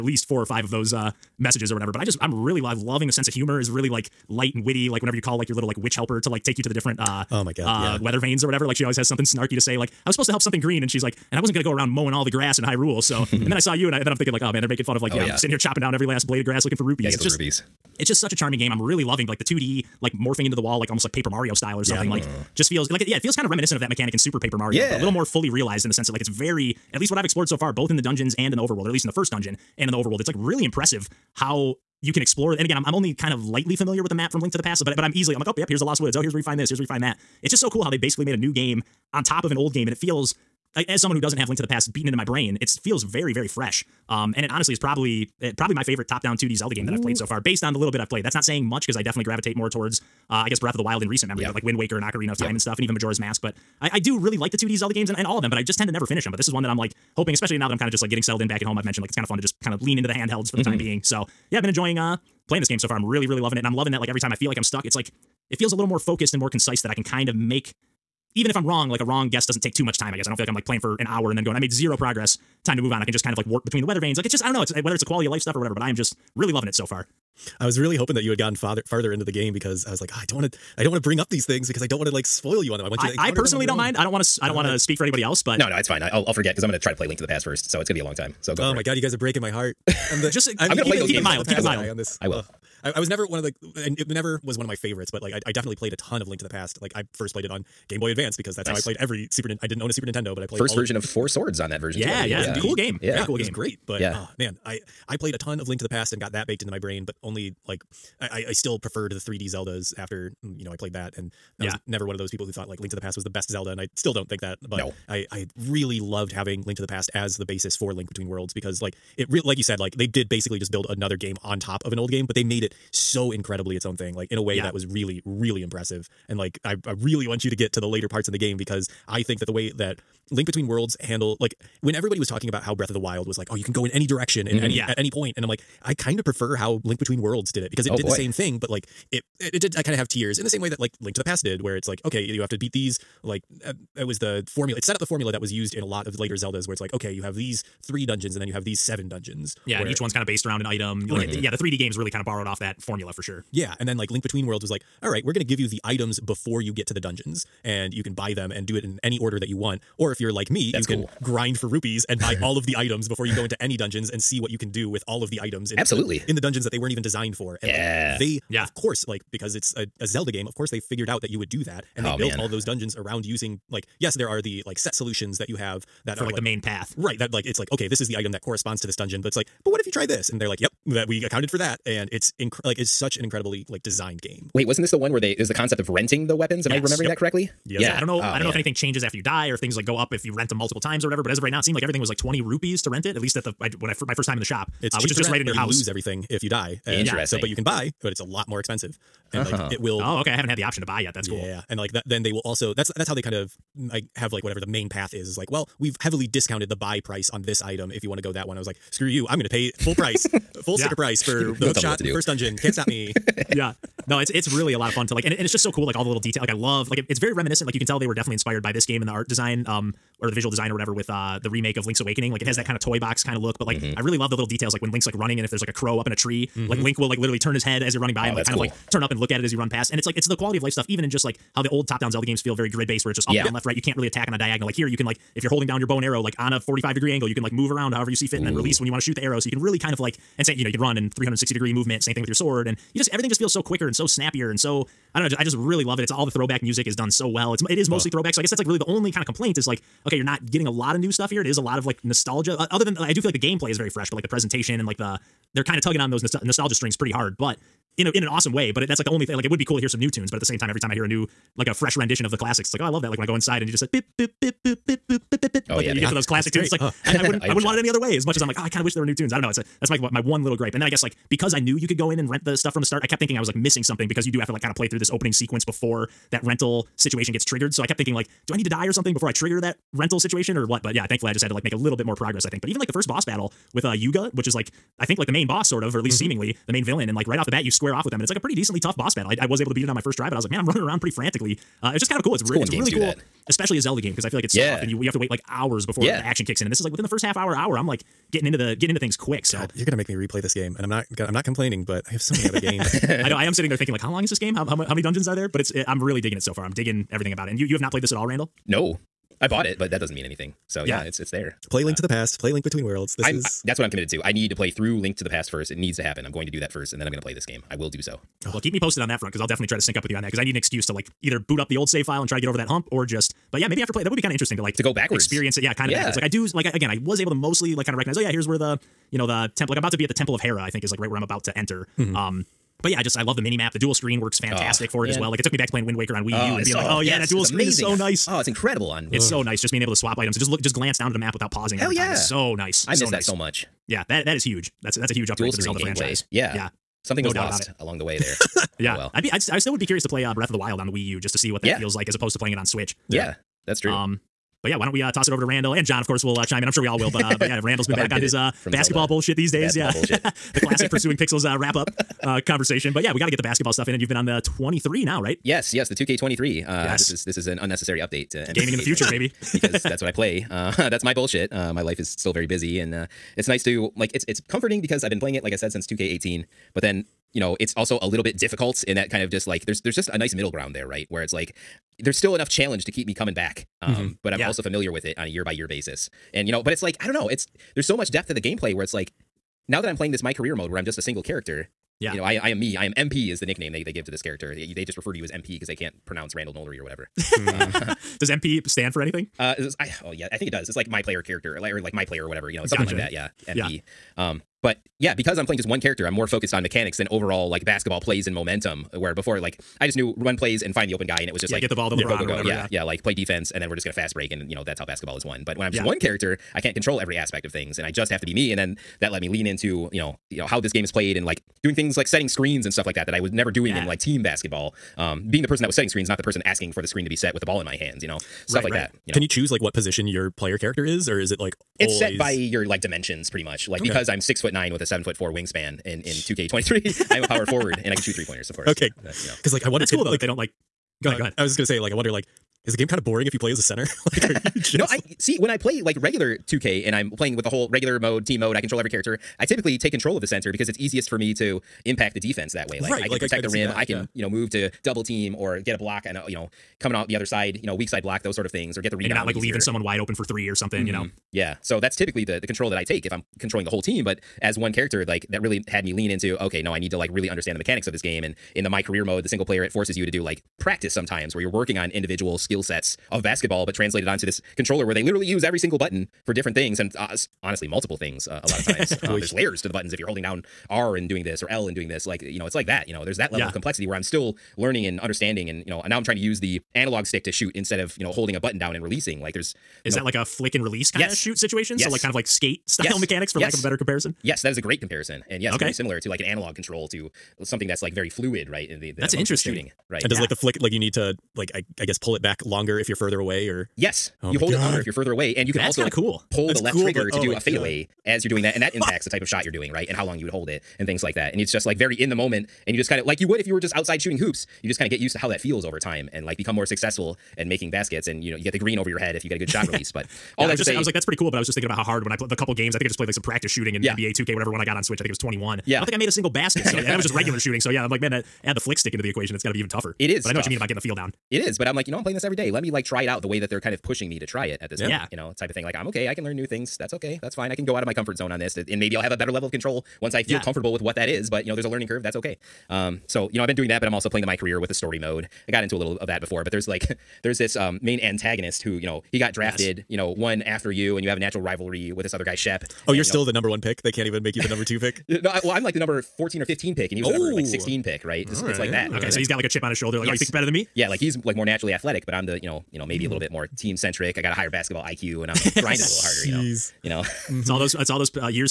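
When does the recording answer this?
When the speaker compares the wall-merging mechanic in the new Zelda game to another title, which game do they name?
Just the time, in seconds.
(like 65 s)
24 s.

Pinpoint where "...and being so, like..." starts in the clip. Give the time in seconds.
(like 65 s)
336 s.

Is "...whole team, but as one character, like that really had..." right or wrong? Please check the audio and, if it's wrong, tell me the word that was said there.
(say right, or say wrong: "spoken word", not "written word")
right.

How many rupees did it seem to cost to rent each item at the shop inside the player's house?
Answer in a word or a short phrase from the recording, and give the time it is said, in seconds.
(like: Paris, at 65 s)
20, at 192 s.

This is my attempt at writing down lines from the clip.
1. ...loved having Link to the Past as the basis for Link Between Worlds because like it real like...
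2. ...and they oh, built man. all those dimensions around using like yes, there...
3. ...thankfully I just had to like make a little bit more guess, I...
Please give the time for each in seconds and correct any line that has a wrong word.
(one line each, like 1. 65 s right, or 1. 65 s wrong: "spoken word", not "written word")
1. 115 s right
2. 171 s wrong: "dungeons", not "dimensions"
3. 281 s wrong: "progress", not "guess".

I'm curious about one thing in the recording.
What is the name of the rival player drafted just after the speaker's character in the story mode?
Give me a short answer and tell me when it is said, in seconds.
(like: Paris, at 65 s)
Shep, at 552 s.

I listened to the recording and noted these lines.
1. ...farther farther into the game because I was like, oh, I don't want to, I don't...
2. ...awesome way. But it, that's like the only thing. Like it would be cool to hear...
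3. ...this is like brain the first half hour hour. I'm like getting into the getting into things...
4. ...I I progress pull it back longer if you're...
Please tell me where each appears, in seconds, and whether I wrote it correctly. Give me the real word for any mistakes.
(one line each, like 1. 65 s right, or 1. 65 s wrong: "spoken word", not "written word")
1. 78 s right
2. 258 s right
3. 296 s wrong: "within", not "brain"
4. 501 s wrong: "guess", not "progress".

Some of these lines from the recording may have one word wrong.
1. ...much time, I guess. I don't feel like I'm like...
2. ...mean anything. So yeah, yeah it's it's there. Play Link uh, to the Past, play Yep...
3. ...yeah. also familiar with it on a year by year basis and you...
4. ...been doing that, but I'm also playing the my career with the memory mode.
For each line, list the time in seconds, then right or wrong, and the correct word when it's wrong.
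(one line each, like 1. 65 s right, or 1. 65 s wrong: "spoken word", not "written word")
1. 69 s right
2. 310 s wrong: "Link", not "Yep"
3. 384 s right
4. 543 s wrong: "story", not "memory".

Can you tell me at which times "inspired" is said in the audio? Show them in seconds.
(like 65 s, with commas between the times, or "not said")
218 s.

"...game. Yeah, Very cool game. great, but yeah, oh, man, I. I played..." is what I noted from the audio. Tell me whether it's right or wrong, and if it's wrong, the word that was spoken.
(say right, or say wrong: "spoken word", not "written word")
right.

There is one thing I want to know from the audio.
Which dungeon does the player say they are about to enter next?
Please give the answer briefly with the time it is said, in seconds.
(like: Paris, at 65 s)
Temple of Hera, at 330 s.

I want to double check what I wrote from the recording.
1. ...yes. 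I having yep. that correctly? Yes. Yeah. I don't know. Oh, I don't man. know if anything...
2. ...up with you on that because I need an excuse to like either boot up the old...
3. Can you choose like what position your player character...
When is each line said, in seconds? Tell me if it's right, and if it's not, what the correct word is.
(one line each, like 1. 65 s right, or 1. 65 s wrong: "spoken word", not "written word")
1. 186 s wrong: "remembering", not "having"
2. 319 s right
3. 429 s right.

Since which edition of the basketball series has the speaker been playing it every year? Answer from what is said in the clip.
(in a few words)
2K18.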